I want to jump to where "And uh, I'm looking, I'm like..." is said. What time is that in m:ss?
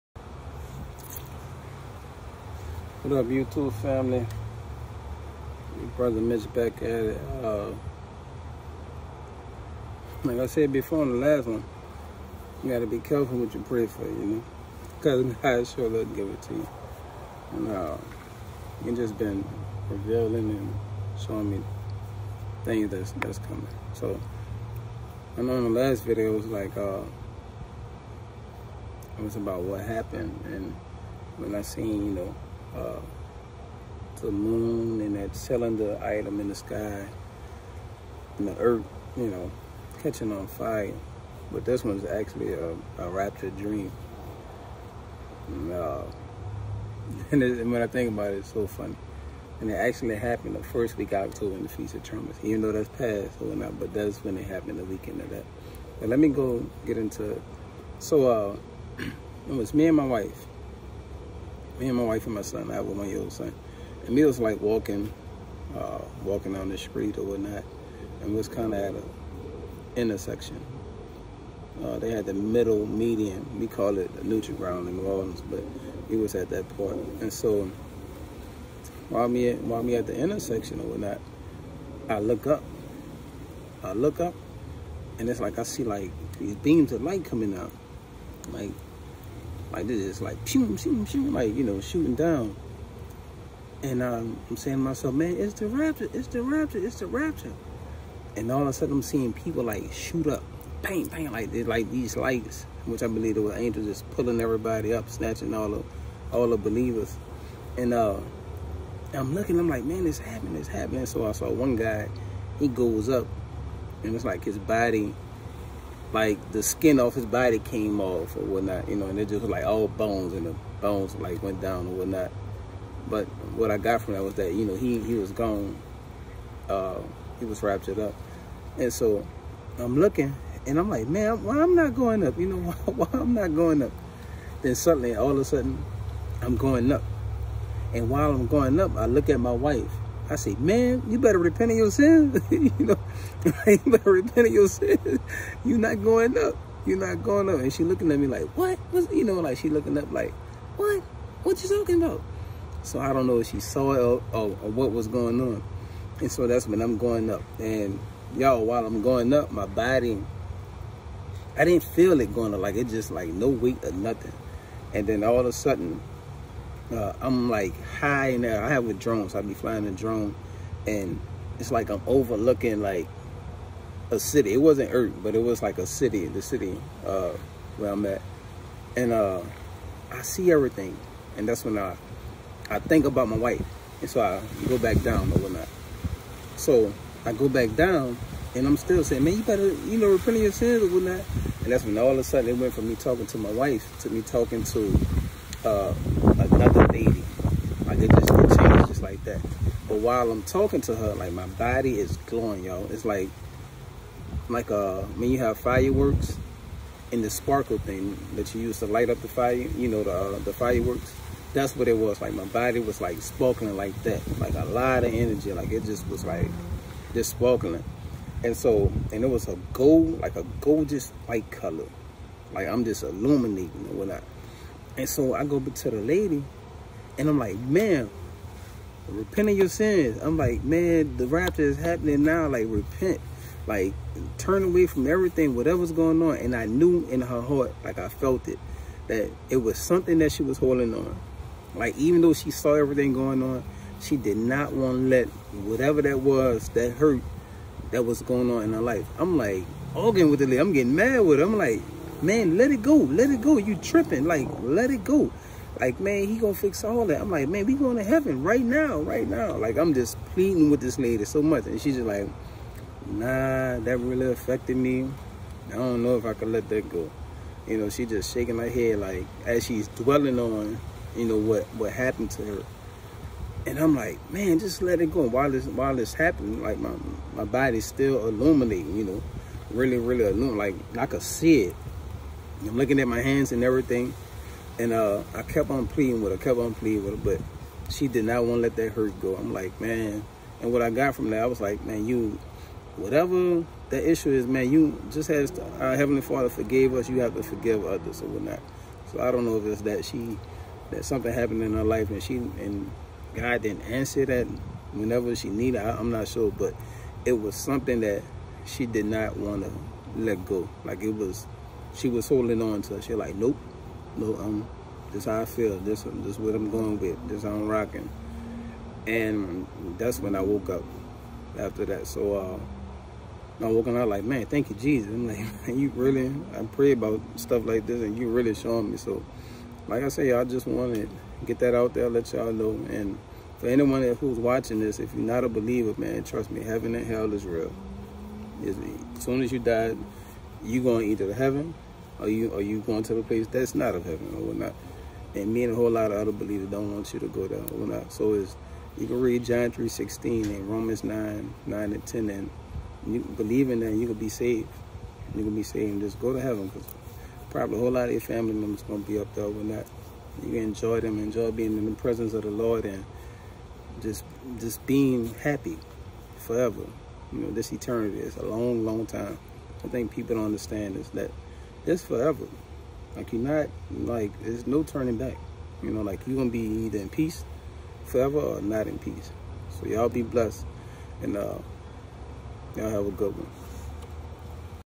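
1:47.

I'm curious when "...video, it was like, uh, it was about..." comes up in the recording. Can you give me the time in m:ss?
0:26.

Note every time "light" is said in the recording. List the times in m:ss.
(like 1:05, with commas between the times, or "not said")
1:27, 1:42, 3:28.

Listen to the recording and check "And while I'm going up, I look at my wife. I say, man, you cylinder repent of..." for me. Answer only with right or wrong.
wrong.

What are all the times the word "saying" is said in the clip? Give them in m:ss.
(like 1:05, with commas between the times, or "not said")
1:34, 3:09.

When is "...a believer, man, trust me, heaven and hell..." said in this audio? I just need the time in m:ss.
5:35.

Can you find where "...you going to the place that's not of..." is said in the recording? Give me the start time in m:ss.
5:42.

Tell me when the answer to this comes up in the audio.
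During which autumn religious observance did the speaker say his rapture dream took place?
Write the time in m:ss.
0:51.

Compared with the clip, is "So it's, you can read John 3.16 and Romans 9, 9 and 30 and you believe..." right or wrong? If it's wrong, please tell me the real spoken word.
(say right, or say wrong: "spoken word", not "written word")
wrong: "10", not "30".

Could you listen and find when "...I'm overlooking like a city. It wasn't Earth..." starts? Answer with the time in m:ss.
2:51.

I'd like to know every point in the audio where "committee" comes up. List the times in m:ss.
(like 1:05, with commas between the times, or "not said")
not said.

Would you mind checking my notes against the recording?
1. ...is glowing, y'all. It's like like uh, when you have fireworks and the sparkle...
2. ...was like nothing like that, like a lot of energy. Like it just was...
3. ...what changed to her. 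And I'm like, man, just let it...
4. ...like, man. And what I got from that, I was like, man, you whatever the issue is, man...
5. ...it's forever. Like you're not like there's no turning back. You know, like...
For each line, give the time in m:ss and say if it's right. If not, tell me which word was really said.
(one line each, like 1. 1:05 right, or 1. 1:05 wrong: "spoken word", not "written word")
1. 3:21 right
2. 3:32 wrong: "sparkling", not "nothing"
3. 4:31 wrong: "happened", not "changed"
4. 4:49 right
5. 6:11 right.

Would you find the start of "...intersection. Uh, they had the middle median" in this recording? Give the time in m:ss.
1:09.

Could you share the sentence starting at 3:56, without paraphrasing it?
And I knew in her heart, like I felt it, that it was something that she was holding on.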